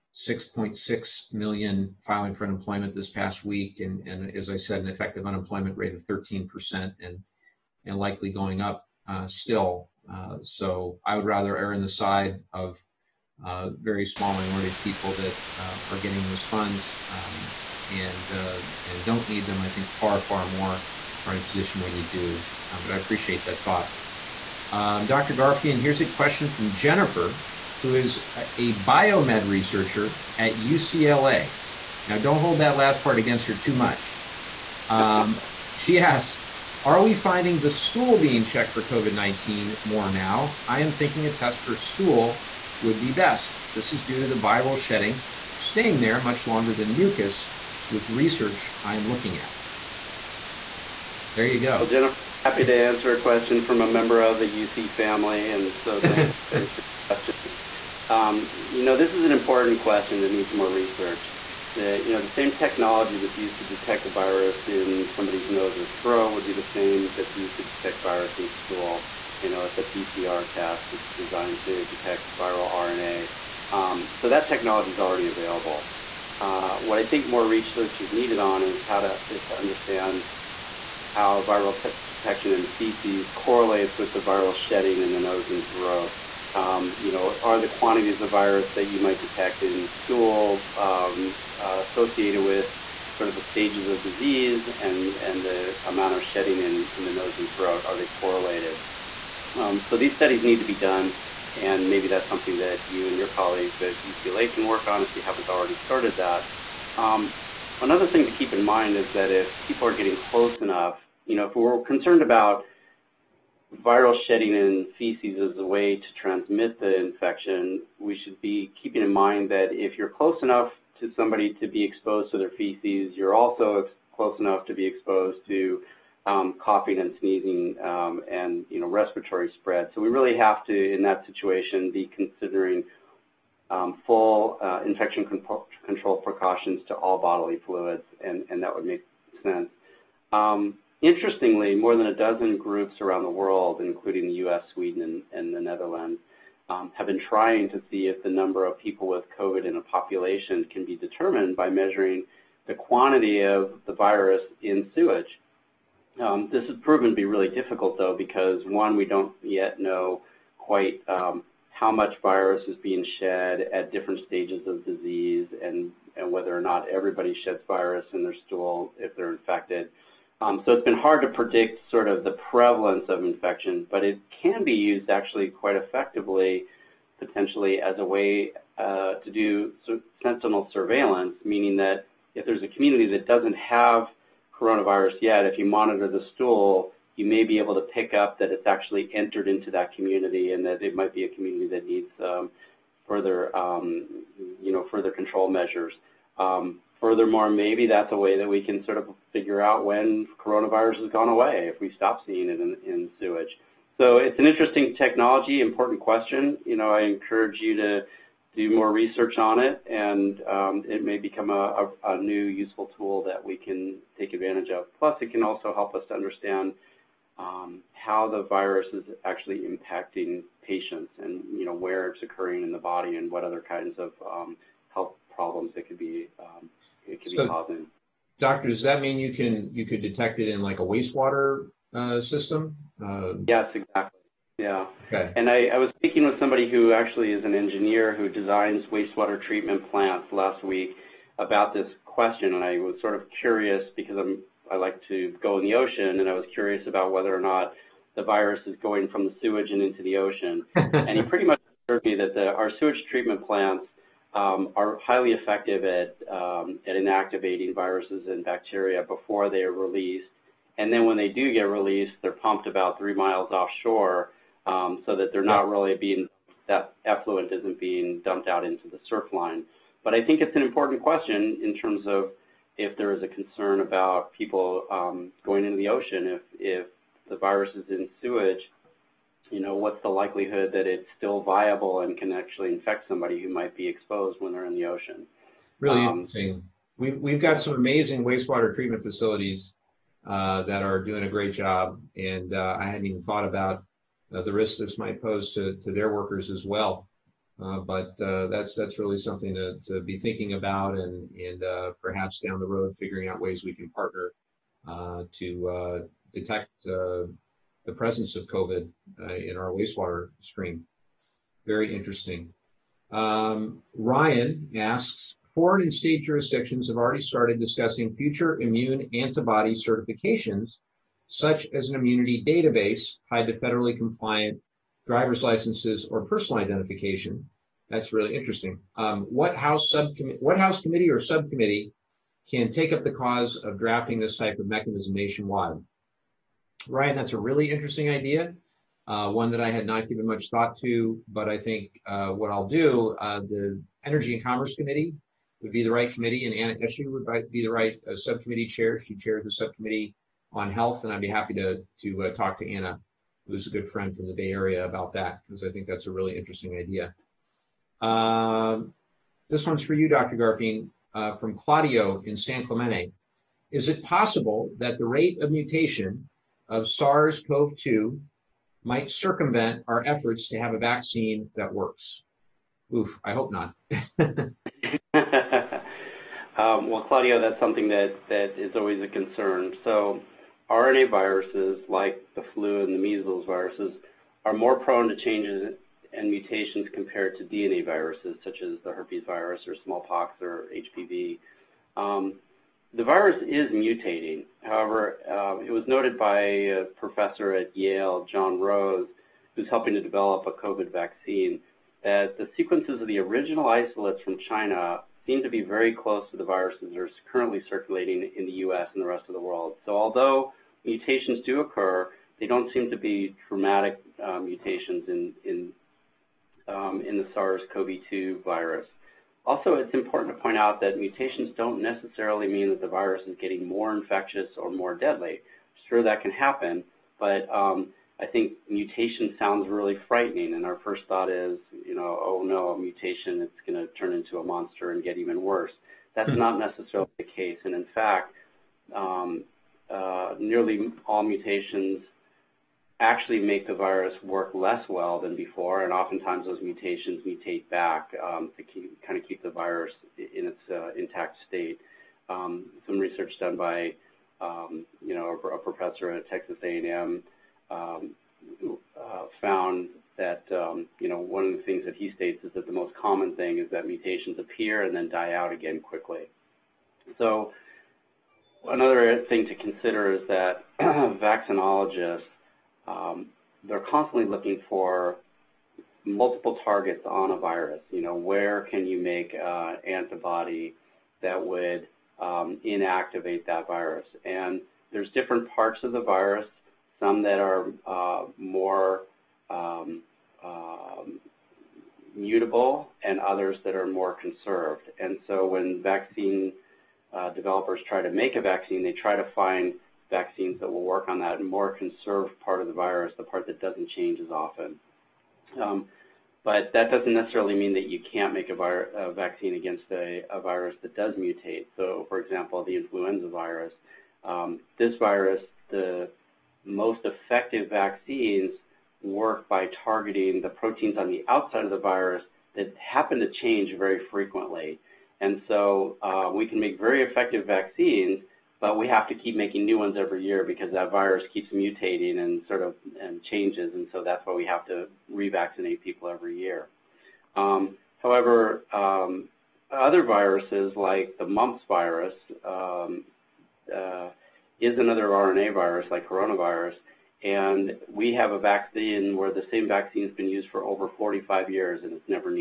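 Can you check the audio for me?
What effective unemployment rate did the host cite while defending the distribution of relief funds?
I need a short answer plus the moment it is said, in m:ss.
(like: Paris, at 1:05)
13%, at 0:06.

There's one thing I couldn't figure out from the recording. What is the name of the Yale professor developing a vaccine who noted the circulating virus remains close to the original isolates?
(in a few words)
John Rose.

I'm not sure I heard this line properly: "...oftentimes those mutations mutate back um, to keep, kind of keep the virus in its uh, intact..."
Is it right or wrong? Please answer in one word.
right.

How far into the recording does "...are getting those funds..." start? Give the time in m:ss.
0:15.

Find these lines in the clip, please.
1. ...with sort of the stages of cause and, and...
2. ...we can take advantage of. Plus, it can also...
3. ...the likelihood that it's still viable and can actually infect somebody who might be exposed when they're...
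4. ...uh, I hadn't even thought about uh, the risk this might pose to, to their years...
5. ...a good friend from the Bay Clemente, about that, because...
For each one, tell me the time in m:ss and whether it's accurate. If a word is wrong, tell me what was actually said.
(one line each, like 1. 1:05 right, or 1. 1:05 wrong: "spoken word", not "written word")
1. 1:32 wrong: "disease", not "cause"
2. 3:33 right
3. 4:40 right
4. 4:52 wrong: "workers", not "years"
5. 5:53 wrong: "Area", not "Clemente".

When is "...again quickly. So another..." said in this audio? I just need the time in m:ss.
7:45.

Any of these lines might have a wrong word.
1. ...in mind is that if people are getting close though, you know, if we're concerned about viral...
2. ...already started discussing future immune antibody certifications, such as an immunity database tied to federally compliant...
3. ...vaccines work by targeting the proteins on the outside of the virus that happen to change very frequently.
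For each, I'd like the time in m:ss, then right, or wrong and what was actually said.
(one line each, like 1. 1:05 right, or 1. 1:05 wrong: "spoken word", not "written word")
1. 1:48 wrong: "enough", not "though"
2. 5:16 right
3. 8:37 right.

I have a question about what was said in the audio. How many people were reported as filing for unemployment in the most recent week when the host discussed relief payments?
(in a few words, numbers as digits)
6.6 million.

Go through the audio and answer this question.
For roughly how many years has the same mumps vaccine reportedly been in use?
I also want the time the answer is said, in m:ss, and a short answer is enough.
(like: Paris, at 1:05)
Over 45 years, at 9:10.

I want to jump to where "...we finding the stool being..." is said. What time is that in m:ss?
0:37.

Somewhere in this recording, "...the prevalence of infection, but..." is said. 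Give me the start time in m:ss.
2:52.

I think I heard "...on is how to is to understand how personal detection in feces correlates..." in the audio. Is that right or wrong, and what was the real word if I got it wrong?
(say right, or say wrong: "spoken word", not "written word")
wrong: "viral", not "personal".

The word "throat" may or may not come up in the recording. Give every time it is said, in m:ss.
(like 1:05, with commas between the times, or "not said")
1:06, 1:25, 1:37.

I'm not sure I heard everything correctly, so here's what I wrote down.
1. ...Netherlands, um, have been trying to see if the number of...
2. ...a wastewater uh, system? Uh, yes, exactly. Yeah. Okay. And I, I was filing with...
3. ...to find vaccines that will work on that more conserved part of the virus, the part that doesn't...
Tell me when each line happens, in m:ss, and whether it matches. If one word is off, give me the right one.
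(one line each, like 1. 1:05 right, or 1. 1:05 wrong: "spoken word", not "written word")
1. 2:25 right
2. 3:50 wrong: "speaking", not "filing"
3. 8:19 right.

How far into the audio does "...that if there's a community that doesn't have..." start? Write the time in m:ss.
3:01.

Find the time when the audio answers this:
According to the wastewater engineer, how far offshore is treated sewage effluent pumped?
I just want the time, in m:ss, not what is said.
4:22.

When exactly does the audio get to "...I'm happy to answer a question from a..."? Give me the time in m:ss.
0:52.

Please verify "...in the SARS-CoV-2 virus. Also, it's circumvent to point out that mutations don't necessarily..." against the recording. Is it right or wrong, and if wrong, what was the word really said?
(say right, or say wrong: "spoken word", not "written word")
wrong: "important", not "circumvent".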